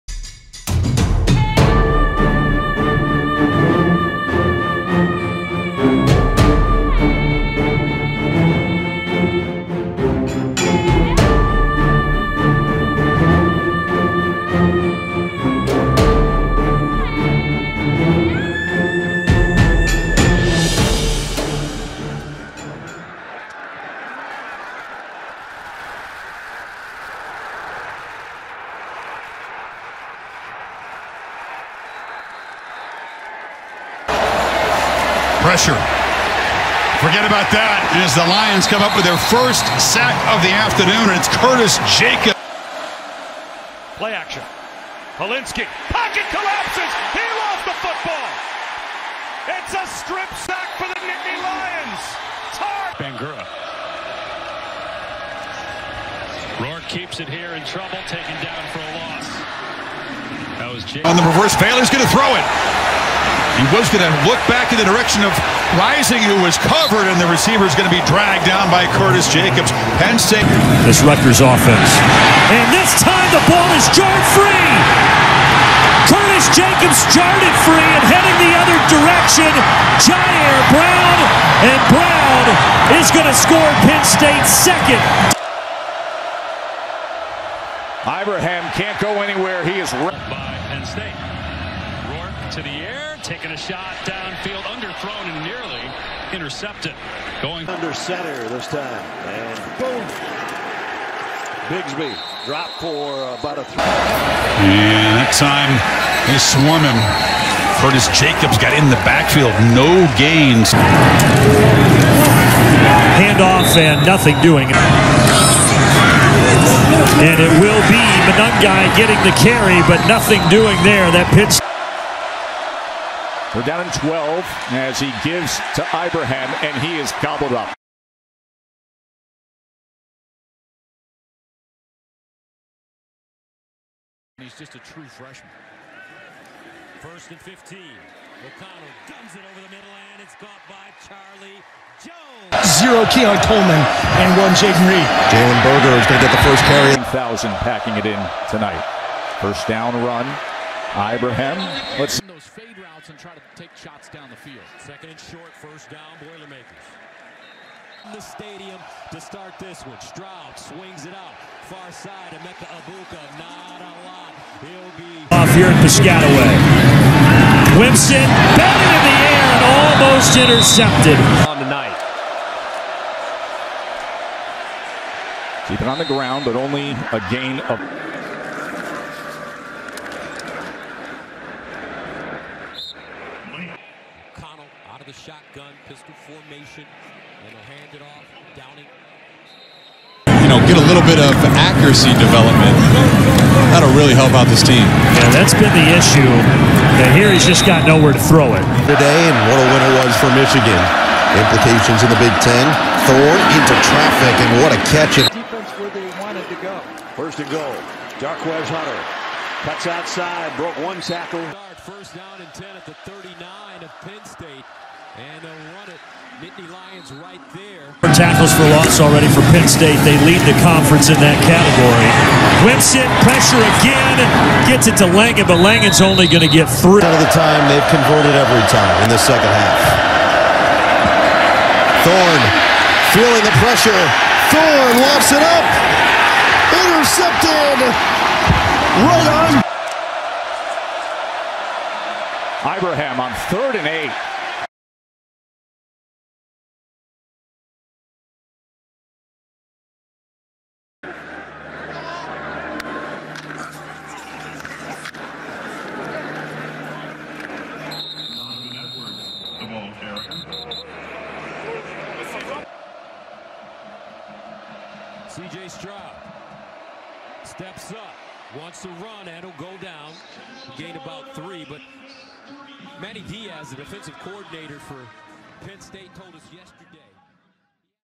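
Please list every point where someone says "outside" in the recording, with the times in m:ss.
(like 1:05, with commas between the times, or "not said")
3:29.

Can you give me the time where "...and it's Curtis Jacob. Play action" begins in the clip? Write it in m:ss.
0:41.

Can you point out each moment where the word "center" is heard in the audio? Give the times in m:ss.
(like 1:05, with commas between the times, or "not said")
1:37.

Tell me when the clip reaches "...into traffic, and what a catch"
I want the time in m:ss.
3:23.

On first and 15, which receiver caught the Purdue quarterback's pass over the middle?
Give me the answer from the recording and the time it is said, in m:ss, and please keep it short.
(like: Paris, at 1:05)
Charlie Jones, at 2:21.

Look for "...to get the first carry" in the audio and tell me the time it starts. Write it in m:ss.
2:26.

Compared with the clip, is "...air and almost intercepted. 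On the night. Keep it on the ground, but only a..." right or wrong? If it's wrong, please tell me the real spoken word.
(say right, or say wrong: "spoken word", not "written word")
right.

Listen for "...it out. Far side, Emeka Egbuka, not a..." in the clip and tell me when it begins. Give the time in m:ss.
2:41.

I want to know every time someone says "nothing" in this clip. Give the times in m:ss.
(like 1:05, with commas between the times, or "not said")
1:54, 2:00.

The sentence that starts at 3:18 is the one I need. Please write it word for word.
Today, and what a winner was for Michigan.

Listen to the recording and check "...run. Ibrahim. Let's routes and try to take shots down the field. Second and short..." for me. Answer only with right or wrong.
right.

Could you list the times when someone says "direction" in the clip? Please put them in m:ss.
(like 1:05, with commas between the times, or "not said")
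1:04, 1:18.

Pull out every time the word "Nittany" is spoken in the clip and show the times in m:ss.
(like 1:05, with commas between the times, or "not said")
0:51, 3:36.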